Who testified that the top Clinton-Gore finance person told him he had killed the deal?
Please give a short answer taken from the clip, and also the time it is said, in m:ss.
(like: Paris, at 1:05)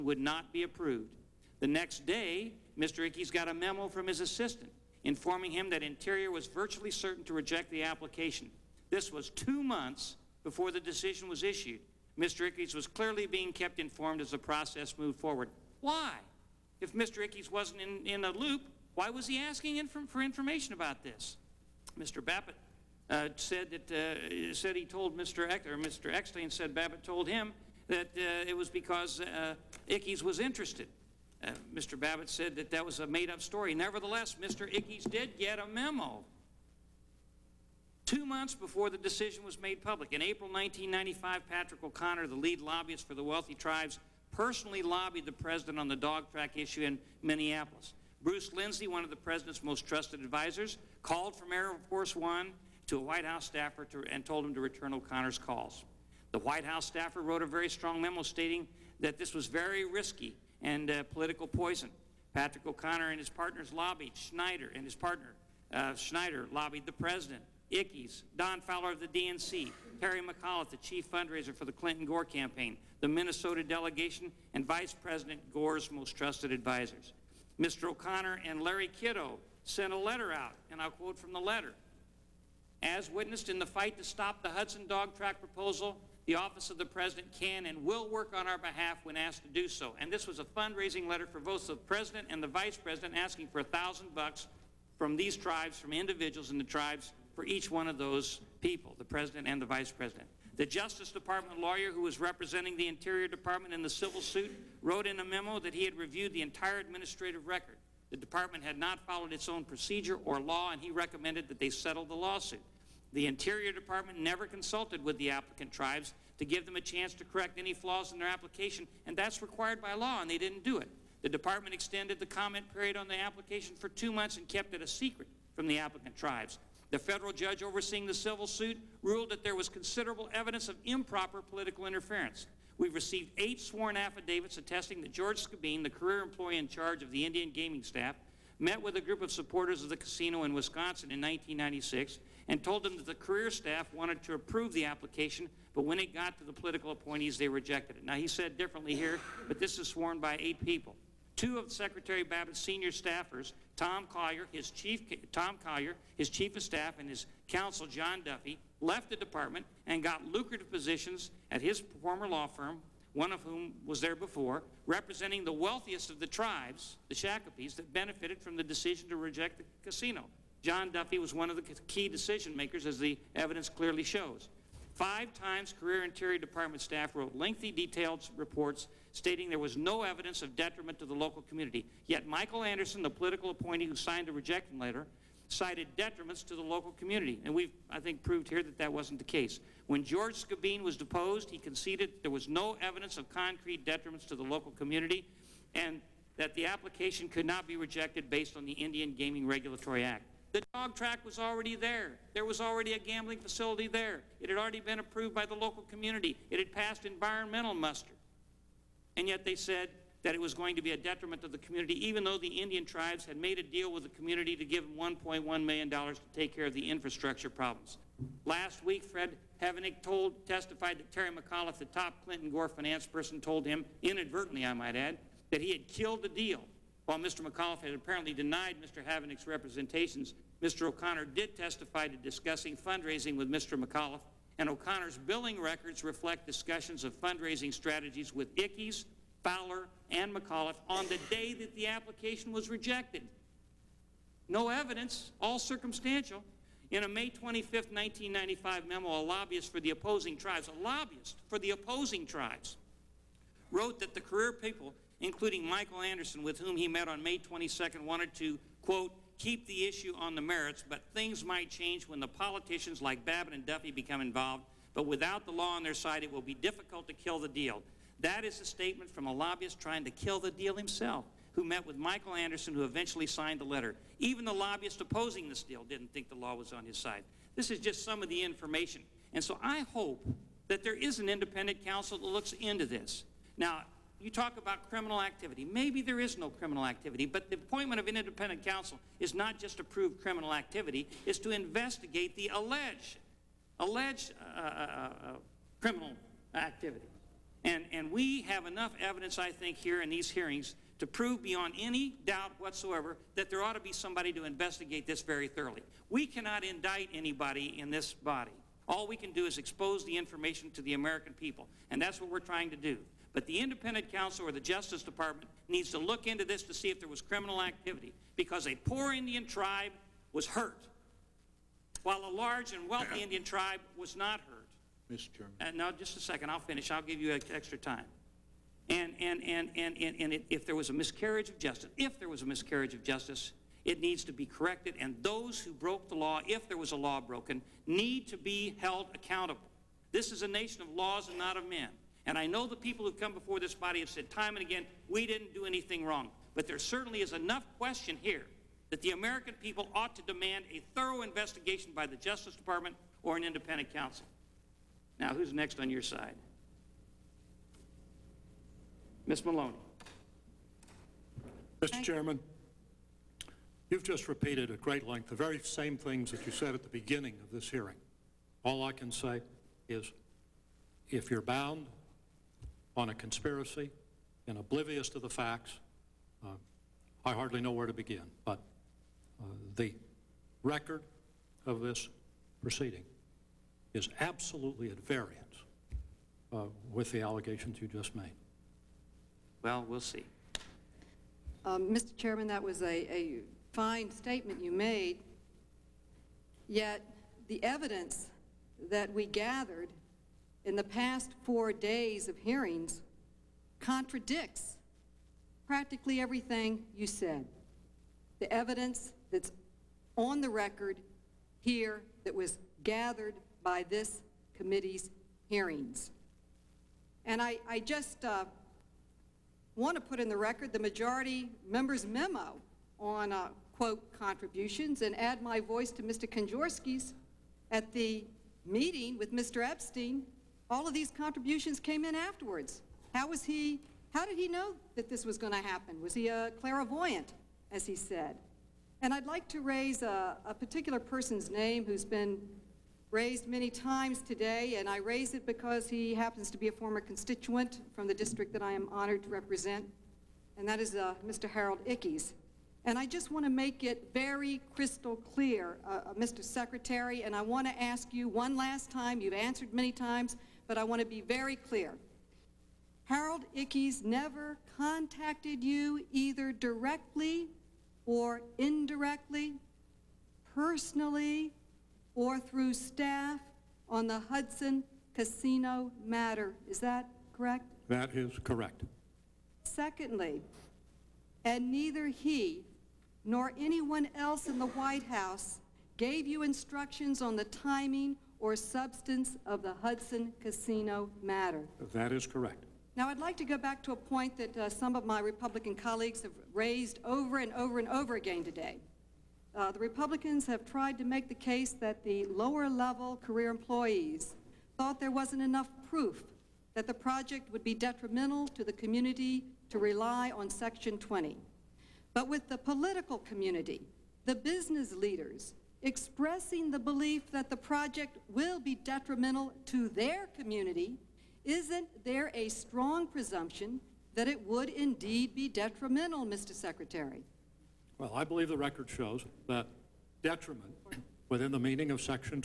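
Fred Havenick, at 3:39.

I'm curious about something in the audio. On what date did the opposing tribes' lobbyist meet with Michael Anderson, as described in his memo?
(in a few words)
May 22.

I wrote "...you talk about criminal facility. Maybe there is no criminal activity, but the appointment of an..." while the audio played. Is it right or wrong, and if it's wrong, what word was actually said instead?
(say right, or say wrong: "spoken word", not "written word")
wrong: "activity", not "facility".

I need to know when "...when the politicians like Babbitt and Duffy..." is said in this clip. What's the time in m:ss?
4:22.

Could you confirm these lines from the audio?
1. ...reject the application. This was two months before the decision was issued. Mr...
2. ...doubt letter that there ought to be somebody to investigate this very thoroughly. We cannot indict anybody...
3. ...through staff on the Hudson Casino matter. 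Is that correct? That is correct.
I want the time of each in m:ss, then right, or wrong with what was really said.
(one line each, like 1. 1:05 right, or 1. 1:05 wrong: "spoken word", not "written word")
1. 0:07 right
2. 5:02 wrong: "whatsoever", not "letter"
3. 7:52 right.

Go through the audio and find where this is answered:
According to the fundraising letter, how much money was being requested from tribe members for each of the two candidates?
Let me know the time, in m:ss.
1:33.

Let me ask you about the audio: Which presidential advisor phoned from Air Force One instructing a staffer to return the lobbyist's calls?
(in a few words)
Bruce Lindsey.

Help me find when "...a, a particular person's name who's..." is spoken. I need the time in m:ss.
7:20.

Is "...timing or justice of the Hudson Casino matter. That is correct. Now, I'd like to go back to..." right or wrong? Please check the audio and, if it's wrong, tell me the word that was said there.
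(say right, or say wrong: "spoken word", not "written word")
wrong: "substance", not "justice".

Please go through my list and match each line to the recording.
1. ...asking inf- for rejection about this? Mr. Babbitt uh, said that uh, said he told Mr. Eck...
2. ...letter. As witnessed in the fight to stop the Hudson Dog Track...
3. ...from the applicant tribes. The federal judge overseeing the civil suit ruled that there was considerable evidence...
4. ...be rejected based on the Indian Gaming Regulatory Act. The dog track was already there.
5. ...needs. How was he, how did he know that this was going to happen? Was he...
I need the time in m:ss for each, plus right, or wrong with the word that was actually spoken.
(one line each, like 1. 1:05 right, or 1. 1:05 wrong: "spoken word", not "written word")
1. 0:19 wrong: "information", not "rejection"
2. 1:21 right
3. 2:05 right
4. 3:17 right
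5. 7:12 wrong: "afterwards", not "needs".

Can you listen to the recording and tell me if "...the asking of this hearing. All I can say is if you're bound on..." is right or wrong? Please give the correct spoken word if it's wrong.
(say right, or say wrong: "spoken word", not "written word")
wrong: "beginning", not "asking".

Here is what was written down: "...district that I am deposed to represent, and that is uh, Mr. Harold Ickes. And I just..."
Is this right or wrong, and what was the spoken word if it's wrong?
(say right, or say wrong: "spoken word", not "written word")
wrong: "honored", not "deposed".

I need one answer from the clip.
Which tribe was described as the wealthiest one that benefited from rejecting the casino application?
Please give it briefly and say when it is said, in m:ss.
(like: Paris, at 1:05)
Shakopees, at 2:47.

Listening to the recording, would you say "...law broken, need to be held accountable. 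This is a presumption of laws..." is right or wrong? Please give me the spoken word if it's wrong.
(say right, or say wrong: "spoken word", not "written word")
wrong: "nation", not "presumption".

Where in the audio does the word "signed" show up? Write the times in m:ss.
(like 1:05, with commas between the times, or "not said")
3:03, 4:33.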